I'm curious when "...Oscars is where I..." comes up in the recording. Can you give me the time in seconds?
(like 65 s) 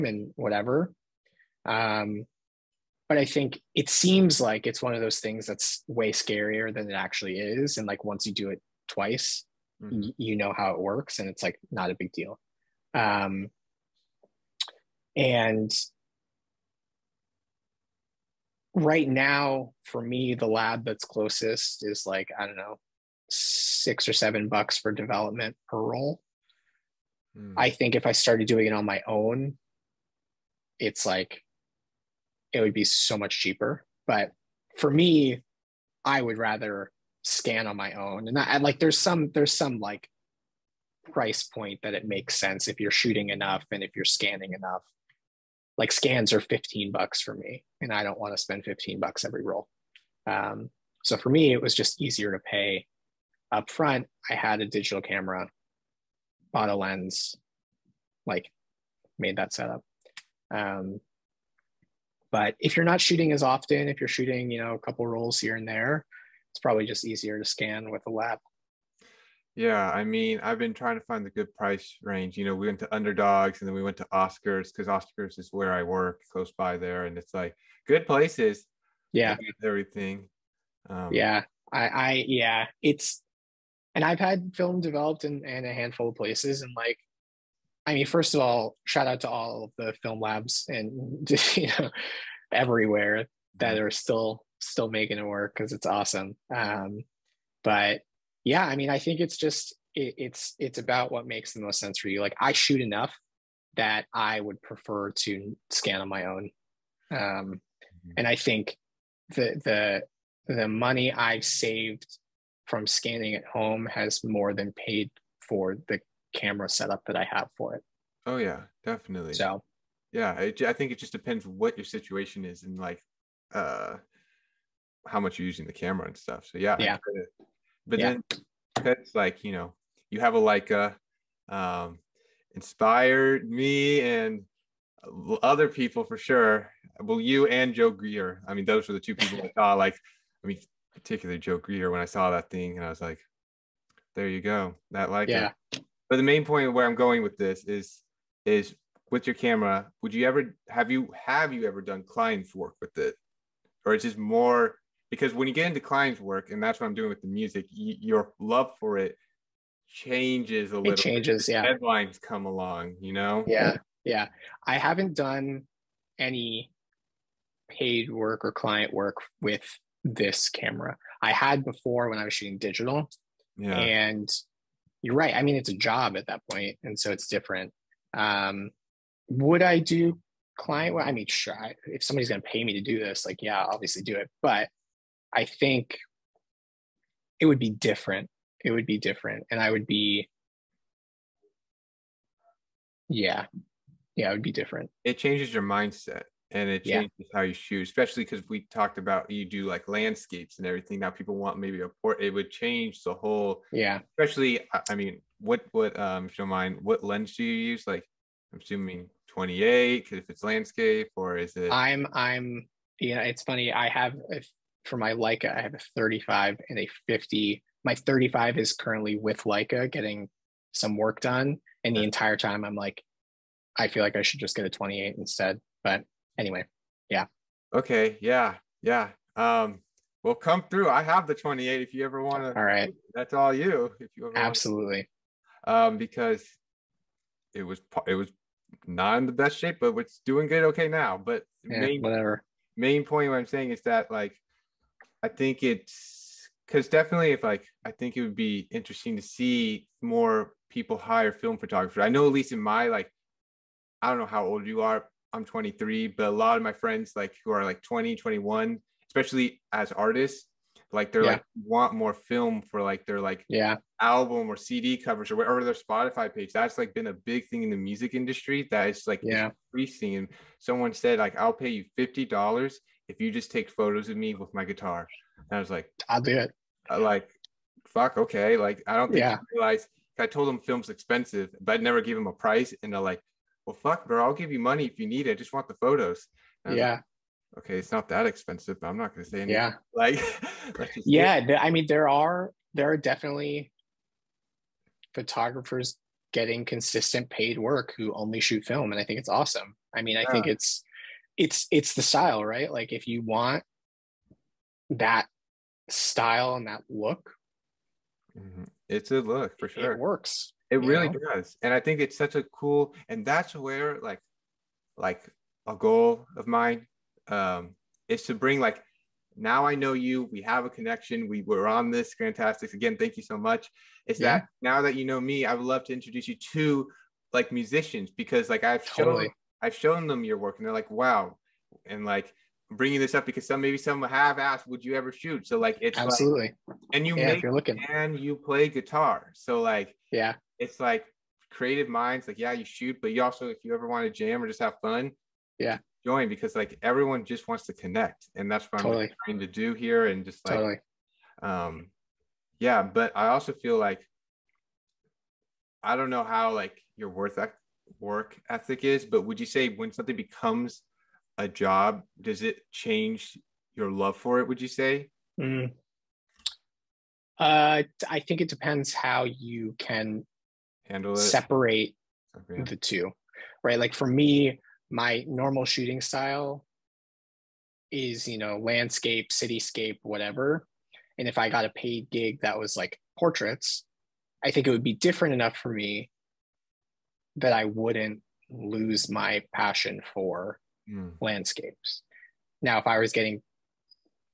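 74 s.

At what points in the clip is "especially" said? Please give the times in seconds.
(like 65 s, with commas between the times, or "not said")
197 s, 204 s, 259 s.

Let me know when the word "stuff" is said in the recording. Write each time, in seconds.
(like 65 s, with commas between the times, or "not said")
126 s.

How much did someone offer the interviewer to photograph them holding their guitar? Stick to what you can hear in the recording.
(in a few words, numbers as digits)
50 dollars.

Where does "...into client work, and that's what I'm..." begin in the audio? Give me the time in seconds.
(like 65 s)
155 s.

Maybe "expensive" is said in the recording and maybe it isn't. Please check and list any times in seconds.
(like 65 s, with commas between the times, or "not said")
280 s, 288 s.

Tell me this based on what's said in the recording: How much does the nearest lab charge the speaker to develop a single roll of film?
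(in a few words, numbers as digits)
6 or 7 dollars.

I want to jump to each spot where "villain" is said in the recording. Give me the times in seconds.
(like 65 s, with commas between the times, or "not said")
not said.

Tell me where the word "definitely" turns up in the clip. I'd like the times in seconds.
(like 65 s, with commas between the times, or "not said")
118 s, 246 s, 292 s.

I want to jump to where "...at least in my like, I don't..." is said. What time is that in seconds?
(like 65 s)
252 s.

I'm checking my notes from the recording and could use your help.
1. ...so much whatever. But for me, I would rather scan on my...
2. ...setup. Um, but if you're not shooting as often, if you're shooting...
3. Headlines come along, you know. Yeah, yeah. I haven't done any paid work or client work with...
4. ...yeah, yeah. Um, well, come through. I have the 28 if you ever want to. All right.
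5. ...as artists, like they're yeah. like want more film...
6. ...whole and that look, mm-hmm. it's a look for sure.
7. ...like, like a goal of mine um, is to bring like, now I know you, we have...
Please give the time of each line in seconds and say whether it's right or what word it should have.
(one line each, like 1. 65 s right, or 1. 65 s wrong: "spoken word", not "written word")
1. 32 s wrong: "cheaper", not "whatever"
2. 59 s right
3. 161 s right
4. 228 s right
5. 259 s right
6. 305 s wrong: "style", not "whole"
7. 314 s right.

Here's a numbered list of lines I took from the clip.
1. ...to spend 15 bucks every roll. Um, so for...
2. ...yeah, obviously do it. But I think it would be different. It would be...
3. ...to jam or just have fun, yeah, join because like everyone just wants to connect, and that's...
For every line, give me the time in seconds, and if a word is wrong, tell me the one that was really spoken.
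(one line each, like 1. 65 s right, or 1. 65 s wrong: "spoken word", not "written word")
1. 48 s right
2. 183 s right
3. 344 s right.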